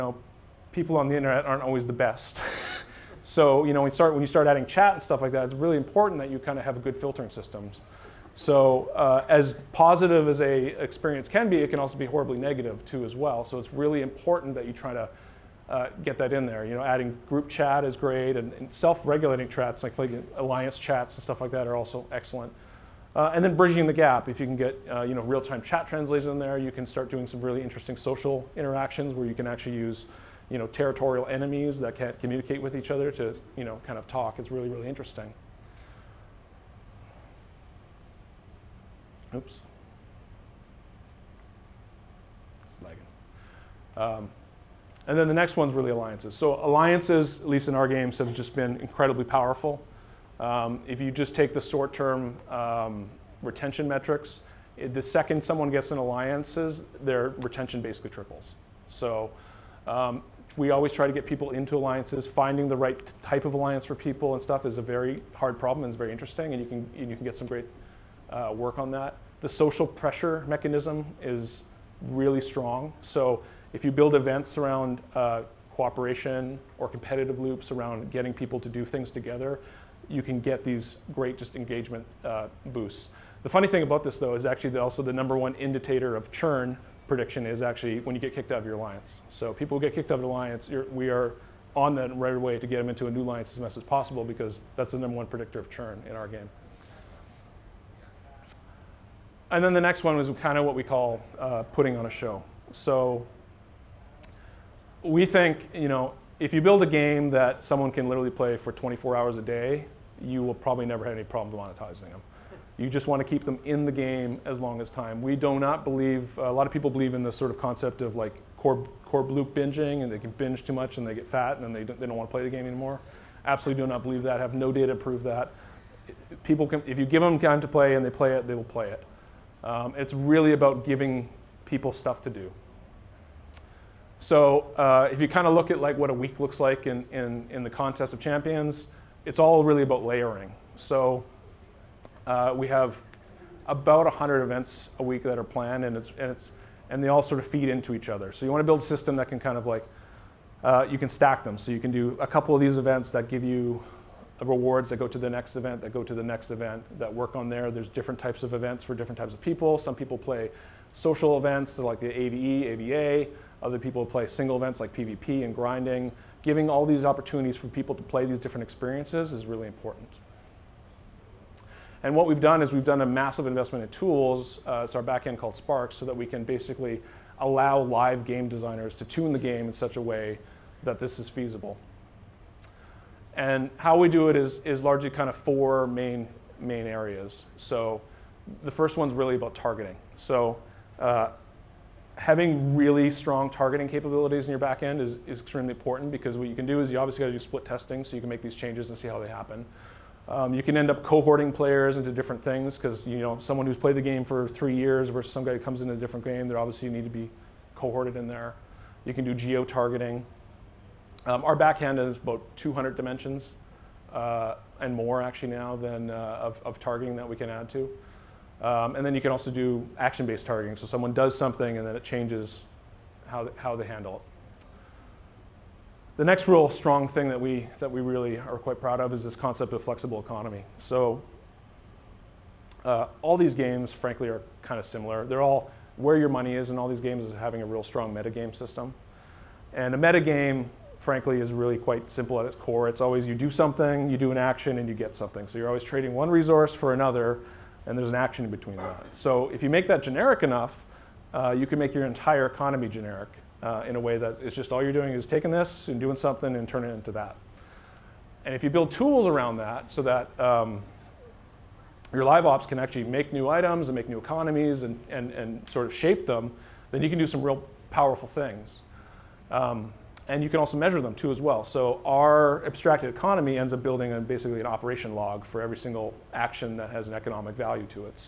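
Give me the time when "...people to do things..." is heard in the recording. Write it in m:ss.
1:18.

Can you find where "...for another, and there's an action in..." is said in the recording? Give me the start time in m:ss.
4:06.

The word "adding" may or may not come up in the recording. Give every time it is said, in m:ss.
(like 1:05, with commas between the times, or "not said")
0:04, 0:16.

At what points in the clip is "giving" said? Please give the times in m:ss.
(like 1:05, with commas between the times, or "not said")
2:10, 2:46.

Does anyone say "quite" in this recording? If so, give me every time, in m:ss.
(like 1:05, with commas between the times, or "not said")
3:48, 4:01.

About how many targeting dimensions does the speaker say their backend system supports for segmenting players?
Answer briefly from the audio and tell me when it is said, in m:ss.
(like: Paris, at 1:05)
200, at 3:32.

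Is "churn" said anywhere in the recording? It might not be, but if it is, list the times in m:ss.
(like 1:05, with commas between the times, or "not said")
1:26, 1:35.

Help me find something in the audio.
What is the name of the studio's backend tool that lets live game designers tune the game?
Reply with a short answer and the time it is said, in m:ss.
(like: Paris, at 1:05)
Spark, at 2:55.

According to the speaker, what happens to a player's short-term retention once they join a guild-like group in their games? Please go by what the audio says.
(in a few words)
Triples.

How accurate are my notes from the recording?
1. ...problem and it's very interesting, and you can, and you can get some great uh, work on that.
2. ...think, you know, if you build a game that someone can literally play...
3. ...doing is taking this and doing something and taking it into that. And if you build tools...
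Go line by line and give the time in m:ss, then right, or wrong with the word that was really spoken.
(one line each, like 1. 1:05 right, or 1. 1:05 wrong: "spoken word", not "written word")
1. 1:05 right
2. 1:45 right
3. 4:14 wrong: "turning", not "taking".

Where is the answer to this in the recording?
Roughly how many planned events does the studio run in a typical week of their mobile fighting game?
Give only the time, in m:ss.
2:24.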